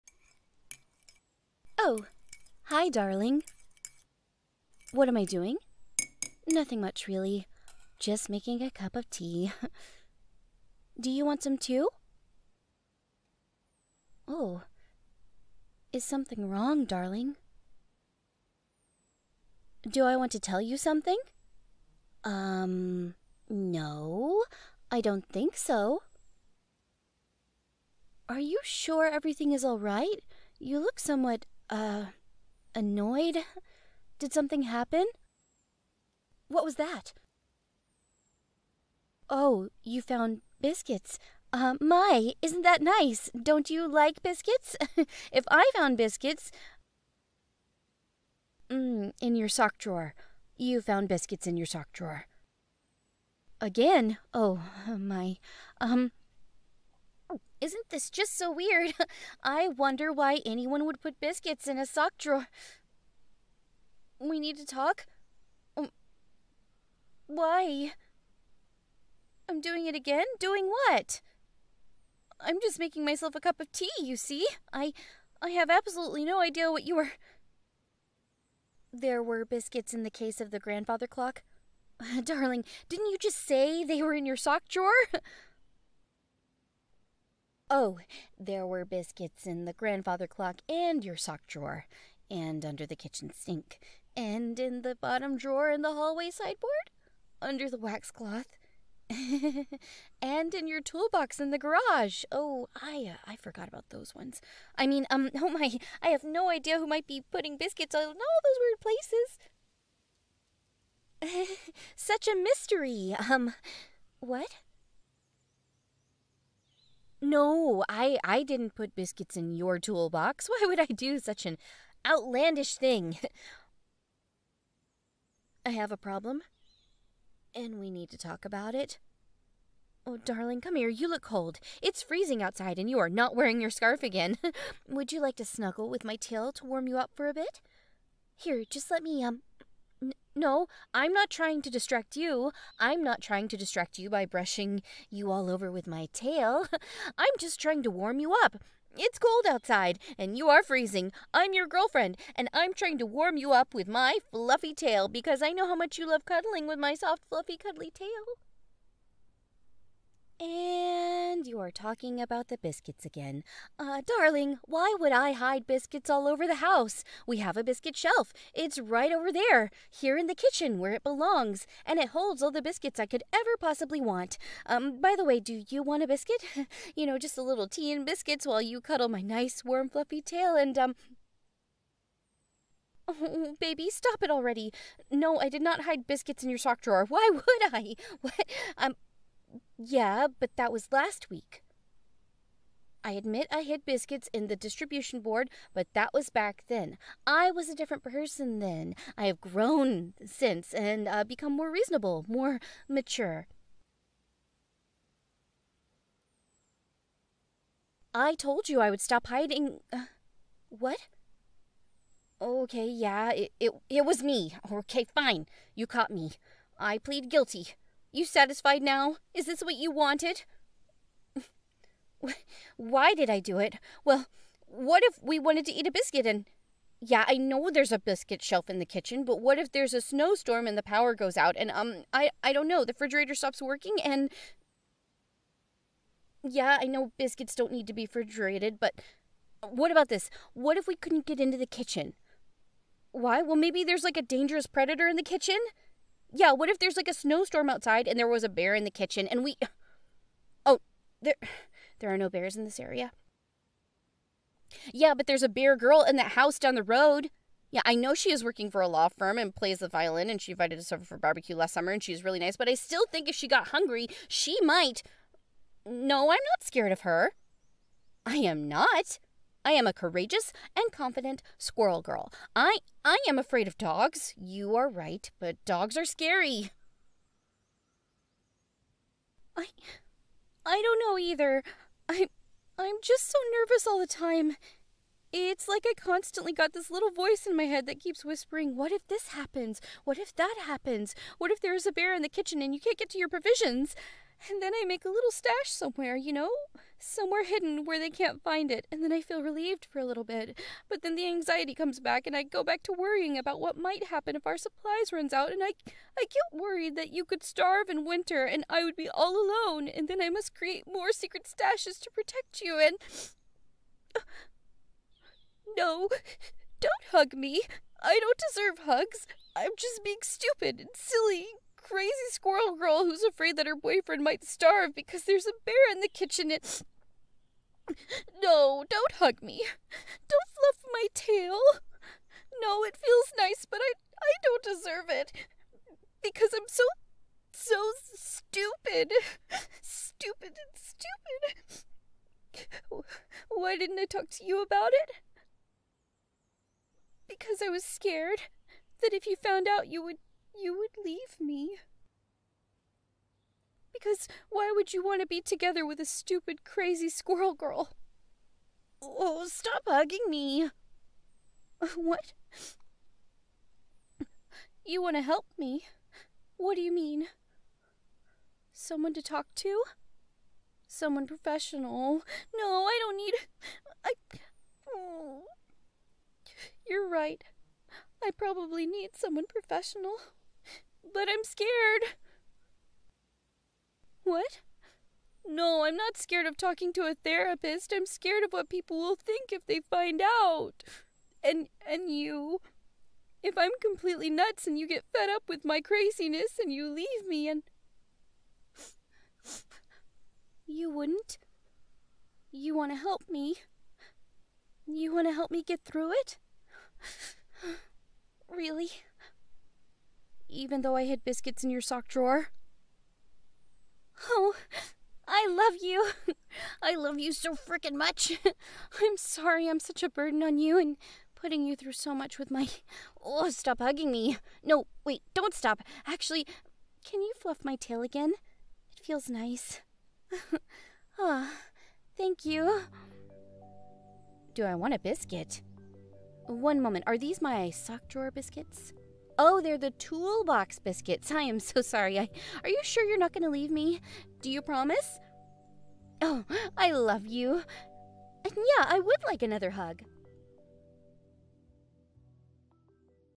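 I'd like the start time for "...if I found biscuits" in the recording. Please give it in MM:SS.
00:45.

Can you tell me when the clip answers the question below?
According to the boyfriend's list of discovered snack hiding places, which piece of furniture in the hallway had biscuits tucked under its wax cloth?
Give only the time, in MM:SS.
01:35.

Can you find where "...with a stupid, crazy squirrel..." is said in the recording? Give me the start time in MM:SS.
05:55.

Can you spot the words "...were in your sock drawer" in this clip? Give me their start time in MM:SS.
01:24.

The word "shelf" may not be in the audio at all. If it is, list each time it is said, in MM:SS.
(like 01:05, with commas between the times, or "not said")
02:47, 03:48.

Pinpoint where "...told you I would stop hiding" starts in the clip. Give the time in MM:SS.
03:28.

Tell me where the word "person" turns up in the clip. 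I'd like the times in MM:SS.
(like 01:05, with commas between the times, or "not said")
03:18.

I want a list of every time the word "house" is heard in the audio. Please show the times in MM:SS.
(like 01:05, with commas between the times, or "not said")
02:46, 04:16.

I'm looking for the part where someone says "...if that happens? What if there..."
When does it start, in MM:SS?
04:50.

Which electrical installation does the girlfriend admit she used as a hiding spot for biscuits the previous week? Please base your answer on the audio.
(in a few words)
distribution board.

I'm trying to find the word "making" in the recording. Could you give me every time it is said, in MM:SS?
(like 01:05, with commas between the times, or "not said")
00:08, 01:12.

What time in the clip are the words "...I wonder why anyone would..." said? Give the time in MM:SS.
00:59.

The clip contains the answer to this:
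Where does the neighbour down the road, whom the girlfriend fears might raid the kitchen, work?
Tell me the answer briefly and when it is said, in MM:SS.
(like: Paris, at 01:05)
law firm, at 04:18.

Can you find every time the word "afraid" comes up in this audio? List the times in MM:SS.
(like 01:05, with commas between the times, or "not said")
04:33, 05:23.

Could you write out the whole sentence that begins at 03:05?
No, I did not hide biscuits in your sock drawer.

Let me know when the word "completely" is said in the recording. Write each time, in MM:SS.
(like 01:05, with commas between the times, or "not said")
06:33.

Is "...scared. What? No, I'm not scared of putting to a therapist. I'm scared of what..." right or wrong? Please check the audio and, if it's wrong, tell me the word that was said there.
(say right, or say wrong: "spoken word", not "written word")
wrong: "talking", not "putting".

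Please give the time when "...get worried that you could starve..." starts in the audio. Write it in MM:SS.
05:06.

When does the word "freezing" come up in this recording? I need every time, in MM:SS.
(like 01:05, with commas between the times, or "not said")
02:12, 02:30.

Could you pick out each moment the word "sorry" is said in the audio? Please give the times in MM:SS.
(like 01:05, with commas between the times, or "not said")
06:59, 07:21.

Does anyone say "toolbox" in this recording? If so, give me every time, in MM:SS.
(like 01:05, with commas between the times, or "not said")
01:40, 01:59, 07:19.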